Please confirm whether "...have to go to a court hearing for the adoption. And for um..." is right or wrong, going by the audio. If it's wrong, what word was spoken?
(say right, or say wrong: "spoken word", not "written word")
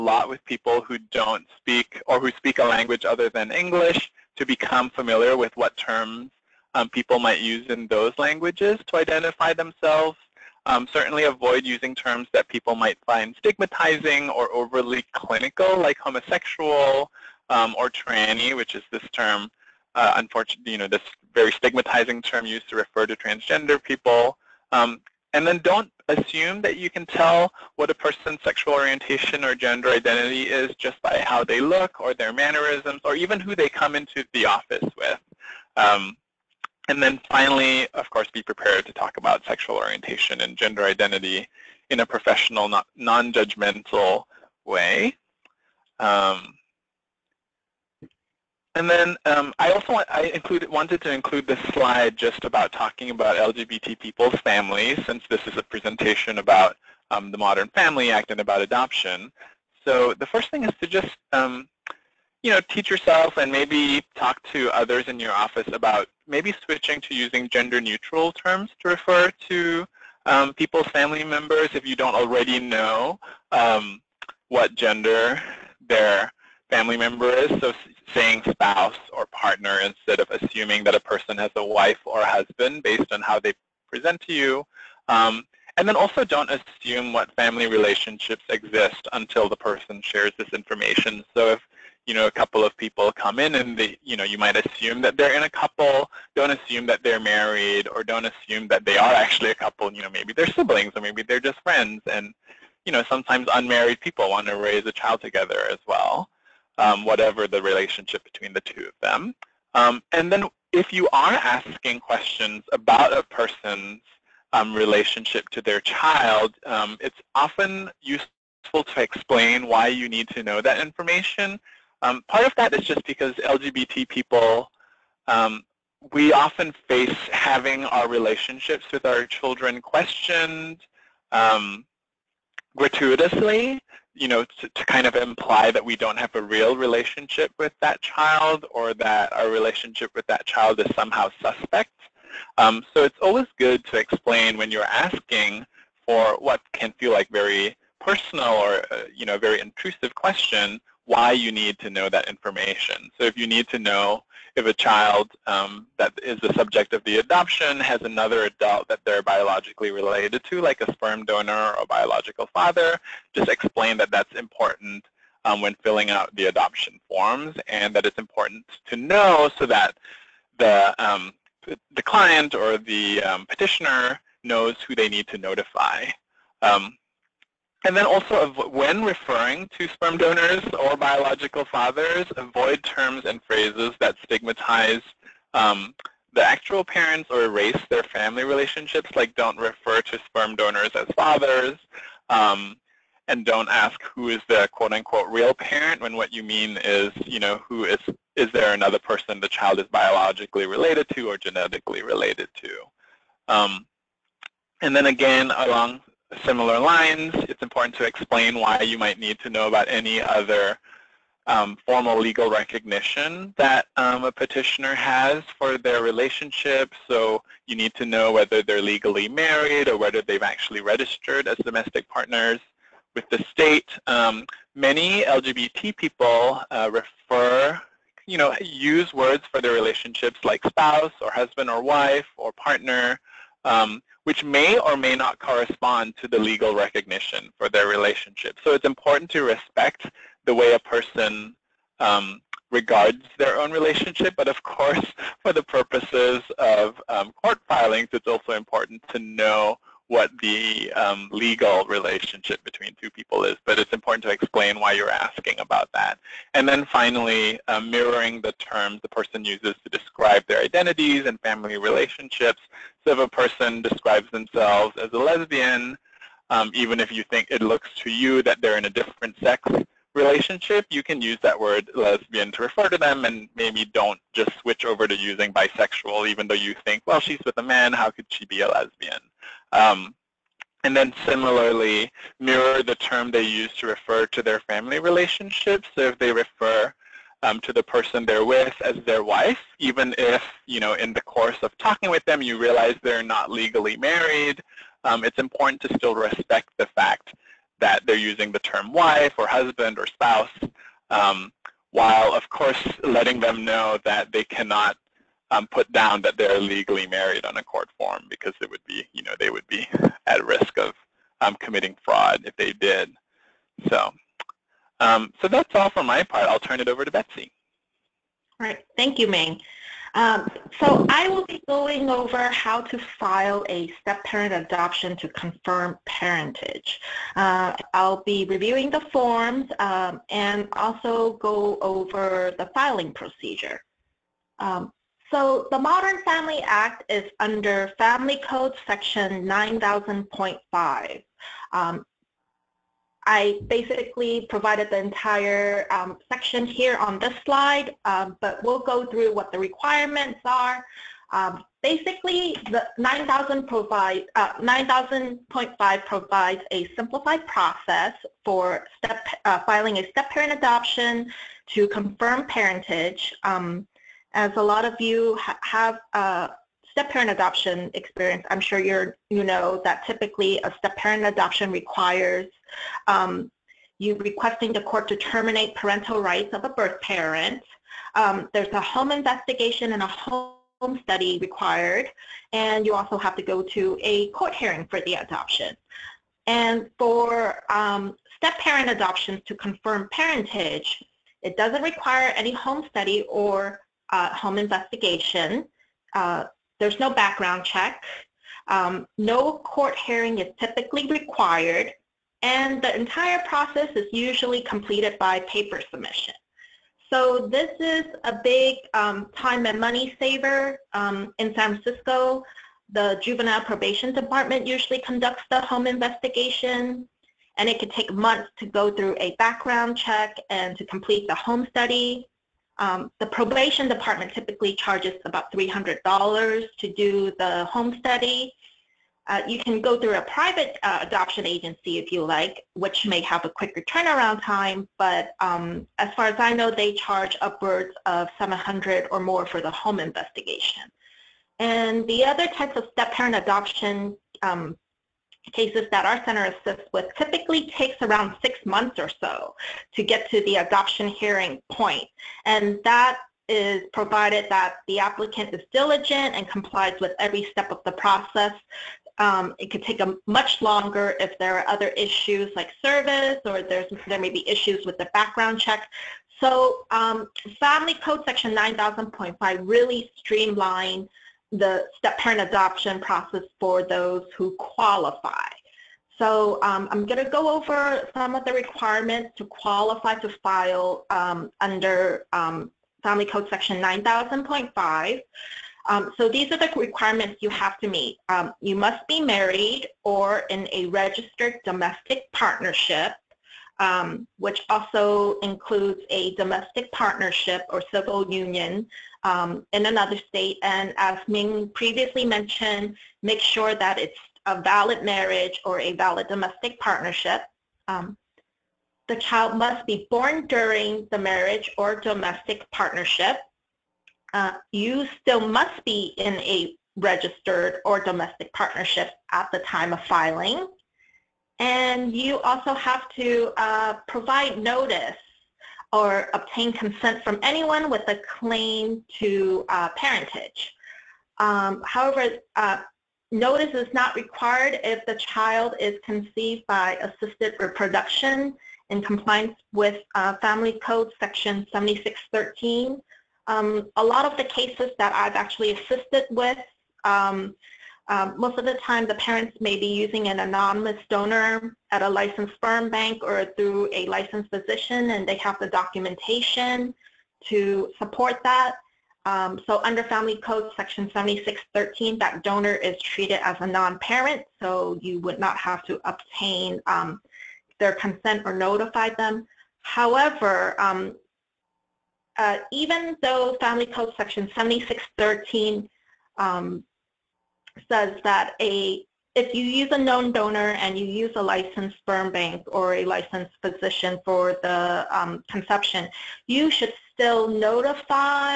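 right.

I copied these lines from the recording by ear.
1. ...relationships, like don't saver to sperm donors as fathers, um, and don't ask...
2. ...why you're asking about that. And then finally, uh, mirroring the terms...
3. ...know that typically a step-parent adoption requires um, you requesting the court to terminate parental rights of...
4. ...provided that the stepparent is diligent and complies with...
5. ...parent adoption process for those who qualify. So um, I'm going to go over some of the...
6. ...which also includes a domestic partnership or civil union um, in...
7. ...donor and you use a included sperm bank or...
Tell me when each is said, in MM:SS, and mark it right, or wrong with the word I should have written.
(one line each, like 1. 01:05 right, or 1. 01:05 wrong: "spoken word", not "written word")
1. 03:08 wrong: "refer", not "saver"
2. 04:14 right
3. 06:09 right
4. 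07:33 wrong: "applicant", not "stepparent"
5. 07:52 right
6. 08:14 right
7. 09:40 wrong: "licensed", not "included".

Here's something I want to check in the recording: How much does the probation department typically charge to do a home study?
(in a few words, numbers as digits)
$300.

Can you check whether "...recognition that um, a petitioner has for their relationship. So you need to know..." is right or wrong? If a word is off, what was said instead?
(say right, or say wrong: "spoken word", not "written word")
right.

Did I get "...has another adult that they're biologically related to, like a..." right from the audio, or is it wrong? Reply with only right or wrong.
right.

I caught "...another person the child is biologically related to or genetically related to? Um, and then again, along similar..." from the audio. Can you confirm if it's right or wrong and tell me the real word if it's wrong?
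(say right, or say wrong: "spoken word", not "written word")
right.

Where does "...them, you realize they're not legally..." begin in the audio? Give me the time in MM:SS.
04:52.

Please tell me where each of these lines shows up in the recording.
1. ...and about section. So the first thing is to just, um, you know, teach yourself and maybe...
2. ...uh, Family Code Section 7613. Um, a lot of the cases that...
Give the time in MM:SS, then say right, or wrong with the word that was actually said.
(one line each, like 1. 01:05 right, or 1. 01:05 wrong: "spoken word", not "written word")
1. 00:58 wrong: "adoption", not "section"
2. 09:00 right.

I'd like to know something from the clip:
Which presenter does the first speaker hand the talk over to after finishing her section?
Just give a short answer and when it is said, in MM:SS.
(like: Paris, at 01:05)
Betsy, at 05:17.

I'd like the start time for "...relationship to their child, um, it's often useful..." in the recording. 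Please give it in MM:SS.
01:54.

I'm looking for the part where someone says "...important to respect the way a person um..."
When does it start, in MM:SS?
03:58.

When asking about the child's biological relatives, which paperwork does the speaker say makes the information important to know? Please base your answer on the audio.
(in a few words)
adoption forms.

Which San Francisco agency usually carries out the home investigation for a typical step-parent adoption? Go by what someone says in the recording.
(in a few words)
Juvenile Probation Department.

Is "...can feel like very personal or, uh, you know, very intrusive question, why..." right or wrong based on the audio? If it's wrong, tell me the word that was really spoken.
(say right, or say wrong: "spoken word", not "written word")
right.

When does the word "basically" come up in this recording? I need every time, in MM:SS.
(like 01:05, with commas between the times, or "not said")
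05:43, 05:51.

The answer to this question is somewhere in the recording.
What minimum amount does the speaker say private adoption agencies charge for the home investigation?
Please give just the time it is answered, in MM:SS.
07:18.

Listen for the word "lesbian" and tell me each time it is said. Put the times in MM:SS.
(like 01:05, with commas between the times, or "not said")
04:25, 04:31, 04:38.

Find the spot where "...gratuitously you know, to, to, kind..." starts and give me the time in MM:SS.
02:12.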